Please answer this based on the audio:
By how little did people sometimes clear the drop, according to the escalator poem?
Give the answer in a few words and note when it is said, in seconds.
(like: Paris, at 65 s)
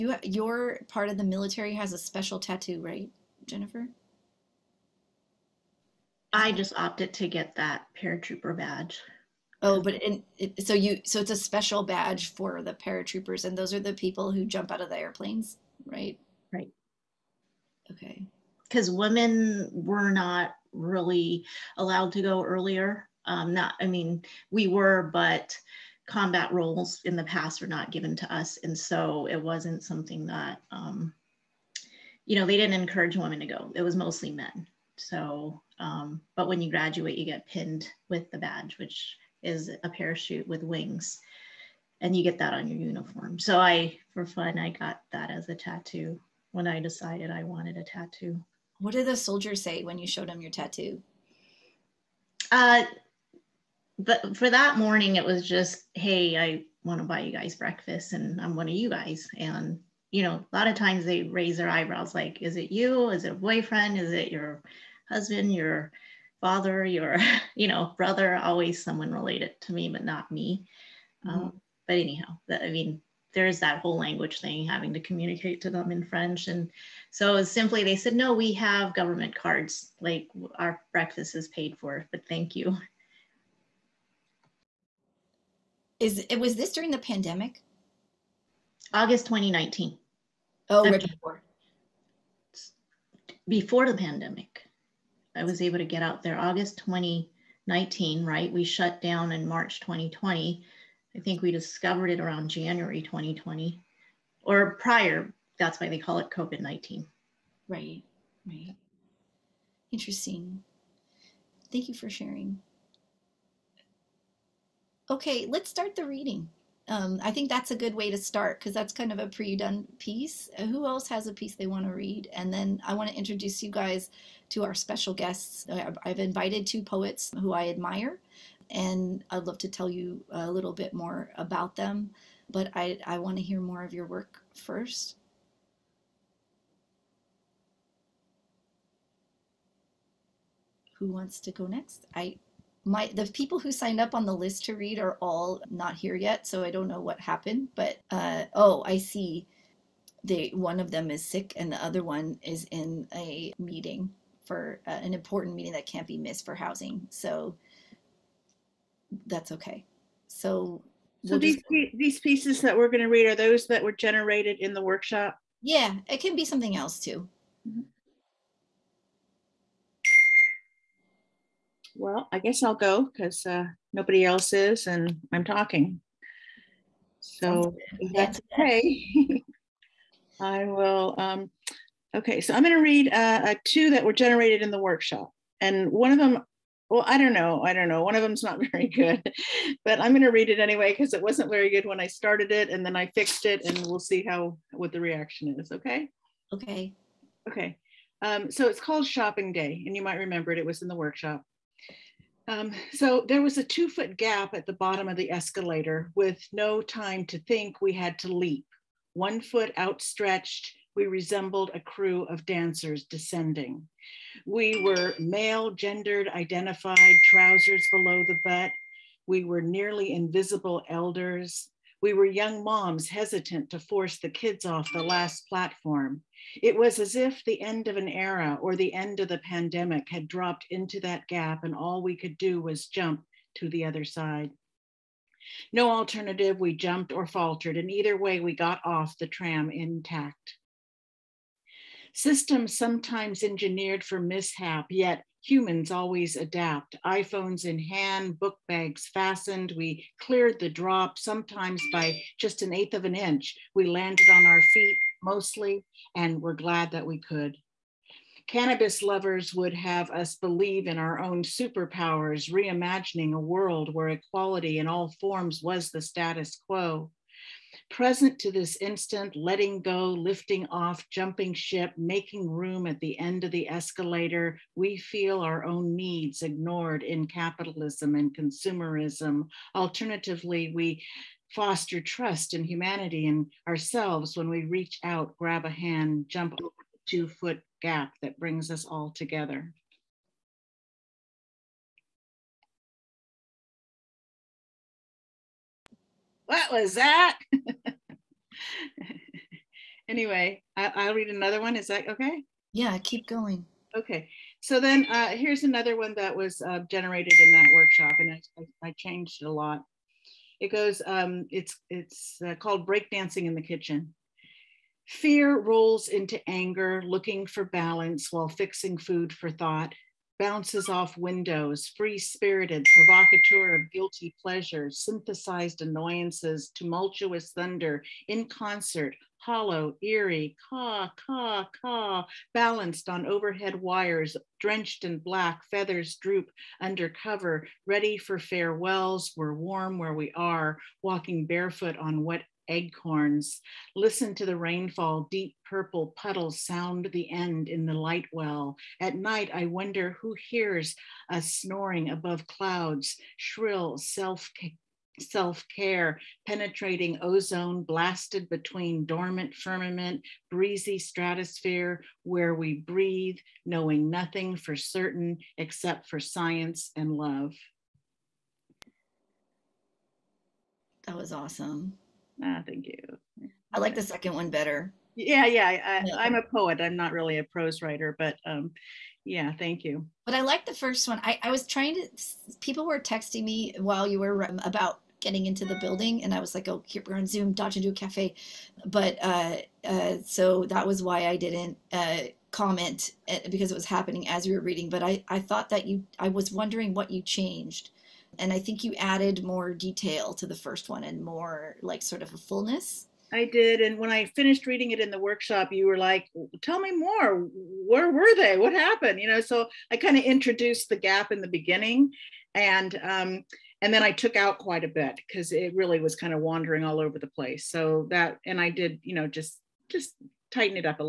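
An eighth of an inch, at 252 s.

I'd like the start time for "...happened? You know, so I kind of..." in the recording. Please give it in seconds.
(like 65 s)
408 s.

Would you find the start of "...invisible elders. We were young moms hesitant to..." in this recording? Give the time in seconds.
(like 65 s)
220 s.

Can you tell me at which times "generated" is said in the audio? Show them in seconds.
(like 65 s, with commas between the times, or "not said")
163 s, 184 s, 306 s.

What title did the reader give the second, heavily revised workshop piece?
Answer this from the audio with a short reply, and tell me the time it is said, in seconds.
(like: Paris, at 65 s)
Breakdancing in the Kitchen, at 312 s.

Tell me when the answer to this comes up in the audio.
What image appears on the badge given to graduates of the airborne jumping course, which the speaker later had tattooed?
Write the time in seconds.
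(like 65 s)
39 s.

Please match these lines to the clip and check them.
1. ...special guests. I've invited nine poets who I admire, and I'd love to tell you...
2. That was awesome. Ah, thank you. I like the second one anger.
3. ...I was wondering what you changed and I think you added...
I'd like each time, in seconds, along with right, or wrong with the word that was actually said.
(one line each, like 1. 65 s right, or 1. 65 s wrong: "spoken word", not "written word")
1. 124 s wrong: "two", not "nine"
2. 371 s wrong: "better", not "anger"
3. 396 s right.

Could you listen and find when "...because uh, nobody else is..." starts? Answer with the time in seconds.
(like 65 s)
173 s.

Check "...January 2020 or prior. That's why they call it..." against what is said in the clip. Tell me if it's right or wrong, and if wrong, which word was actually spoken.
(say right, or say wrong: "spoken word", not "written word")
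right.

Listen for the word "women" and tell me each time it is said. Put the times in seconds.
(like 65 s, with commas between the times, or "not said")
18 s, 33 s.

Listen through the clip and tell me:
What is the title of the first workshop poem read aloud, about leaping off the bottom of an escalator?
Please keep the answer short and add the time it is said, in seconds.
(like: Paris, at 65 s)
Shopping Day, at 199 s.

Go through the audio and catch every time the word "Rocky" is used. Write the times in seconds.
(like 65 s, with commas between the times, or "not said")
not said.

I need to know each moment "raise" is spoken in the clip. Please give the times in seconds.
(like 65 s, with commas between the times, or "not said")
61 s.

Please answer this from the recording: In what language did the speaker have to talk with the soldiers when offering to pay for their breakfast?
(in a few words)
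French.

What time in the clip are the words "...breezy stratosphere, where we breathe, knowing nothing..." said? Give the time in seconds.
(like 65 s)
360 s.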